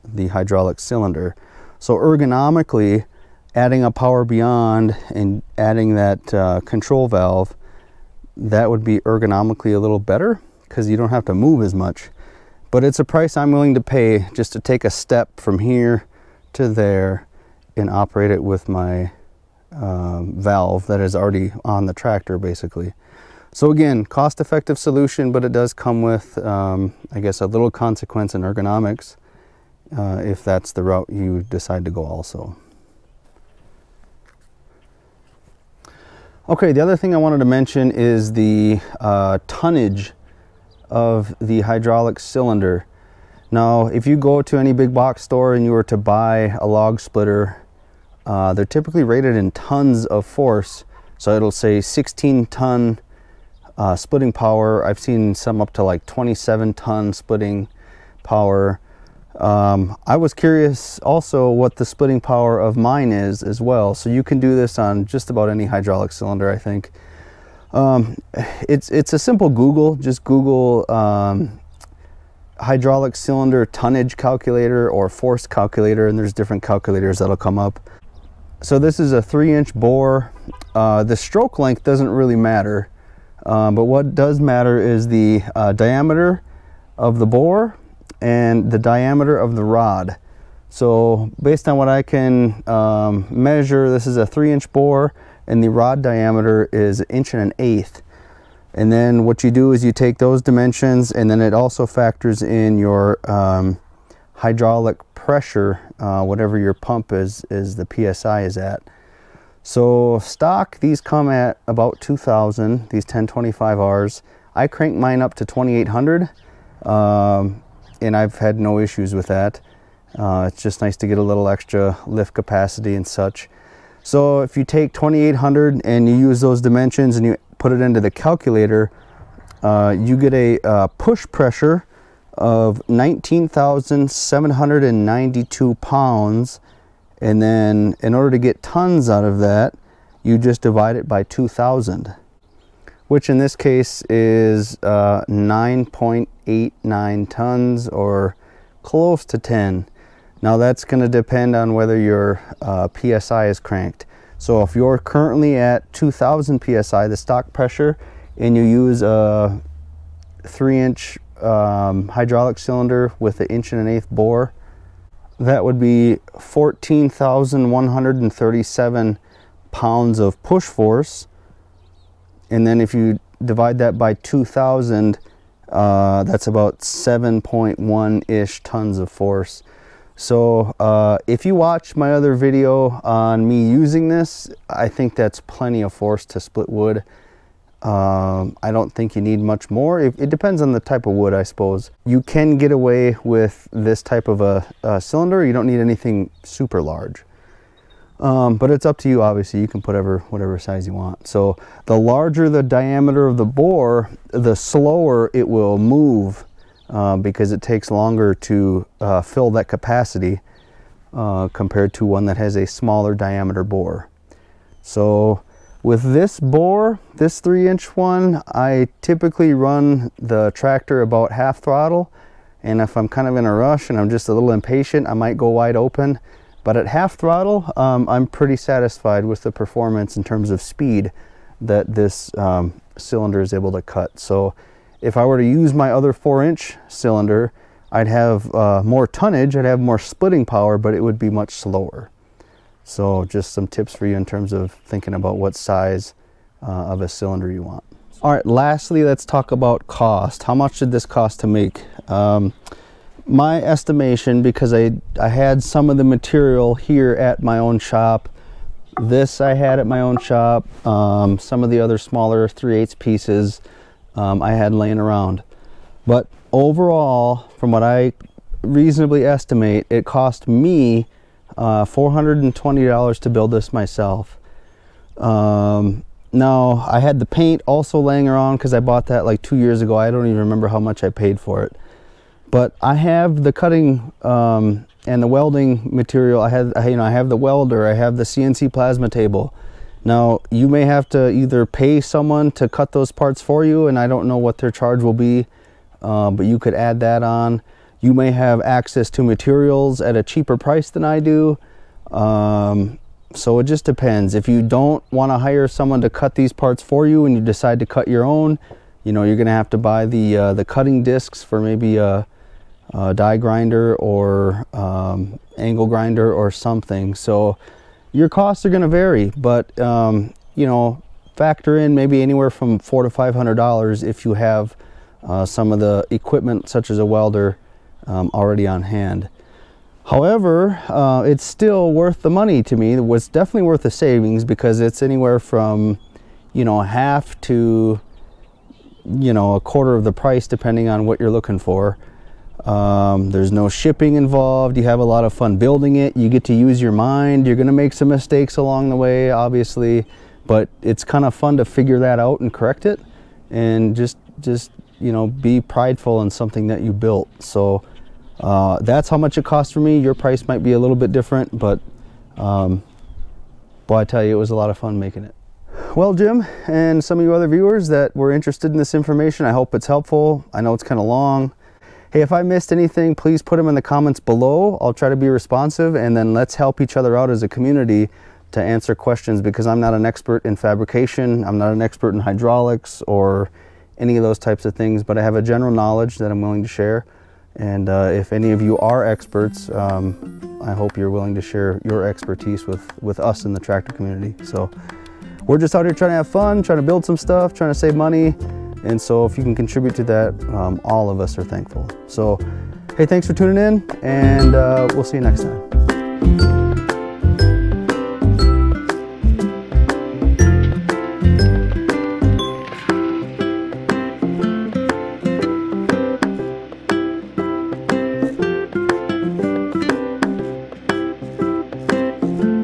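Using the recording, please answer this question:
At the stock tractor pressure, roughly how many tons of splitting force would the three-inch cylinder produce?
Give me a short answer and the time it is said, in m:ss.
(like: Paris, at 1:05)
7.1 tons, at 2:56.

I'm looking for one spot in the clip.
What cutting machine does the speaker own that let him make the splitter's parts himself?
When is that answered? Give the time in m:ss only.
4:48.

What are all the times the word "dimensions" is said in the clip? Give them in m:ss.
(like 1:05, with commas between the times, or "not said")
1:40, 2:06.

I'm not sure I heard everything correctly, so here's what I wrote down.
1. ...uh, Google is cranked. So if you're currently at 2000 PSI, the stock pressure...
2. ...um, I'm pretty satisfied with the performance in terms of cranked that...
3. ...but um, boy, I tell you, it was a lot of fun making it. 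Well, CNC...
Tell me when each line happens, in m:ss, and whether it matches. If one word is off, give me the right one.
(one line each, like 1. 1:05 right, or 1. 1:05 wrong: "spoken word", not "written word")
1. 2:32 wrong: "PSI", not "Google"
2. 3:47 wrong: "speed", not "cranked"
3. 6:01 wrong: "Jim", not "CNC".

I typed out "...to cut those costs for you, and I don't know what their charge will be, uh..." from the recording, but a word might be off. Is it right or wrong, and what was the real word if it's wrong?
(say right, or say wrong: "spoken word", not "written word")
wrong: "parts", not "costs".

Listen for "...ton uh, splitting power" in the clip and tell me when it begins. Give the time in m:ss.
0:52.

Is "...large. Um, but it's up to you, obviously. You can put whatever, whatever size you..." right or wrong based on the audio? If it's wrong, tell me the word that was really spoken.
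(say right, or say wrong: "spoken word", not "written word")
right.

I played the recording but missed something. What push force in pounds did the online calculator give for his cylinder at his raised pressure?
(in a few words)
19,792 pounds.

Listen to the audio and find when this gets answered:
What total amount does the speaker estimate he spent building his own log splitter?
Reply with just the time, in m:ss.
4:31.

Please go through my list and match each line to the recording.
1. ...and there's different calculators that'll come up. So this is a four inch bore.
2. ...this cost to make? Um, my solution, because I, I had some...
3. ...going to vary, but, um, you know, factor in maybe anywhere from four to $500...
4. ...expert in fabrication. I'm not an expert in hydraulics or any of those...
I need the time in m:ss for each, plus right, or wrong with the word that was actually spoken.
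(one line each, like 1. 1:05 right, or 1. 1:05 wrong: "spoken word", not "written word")
1. 1:16 wrong: "three", not "four"
2. 4:10 wrong: "estimation", not "solution"
3. 5:18 right
4. 6:20 right.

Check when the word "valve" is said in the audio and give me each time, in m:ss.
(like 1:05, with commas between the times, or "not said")
0:07, 0:20.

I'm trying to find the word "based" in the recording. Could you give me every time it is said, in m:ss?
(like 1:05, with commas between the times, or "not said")
1:31.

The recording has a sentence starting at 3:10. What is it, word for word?
It, it, depends on the type of wood, I suppose.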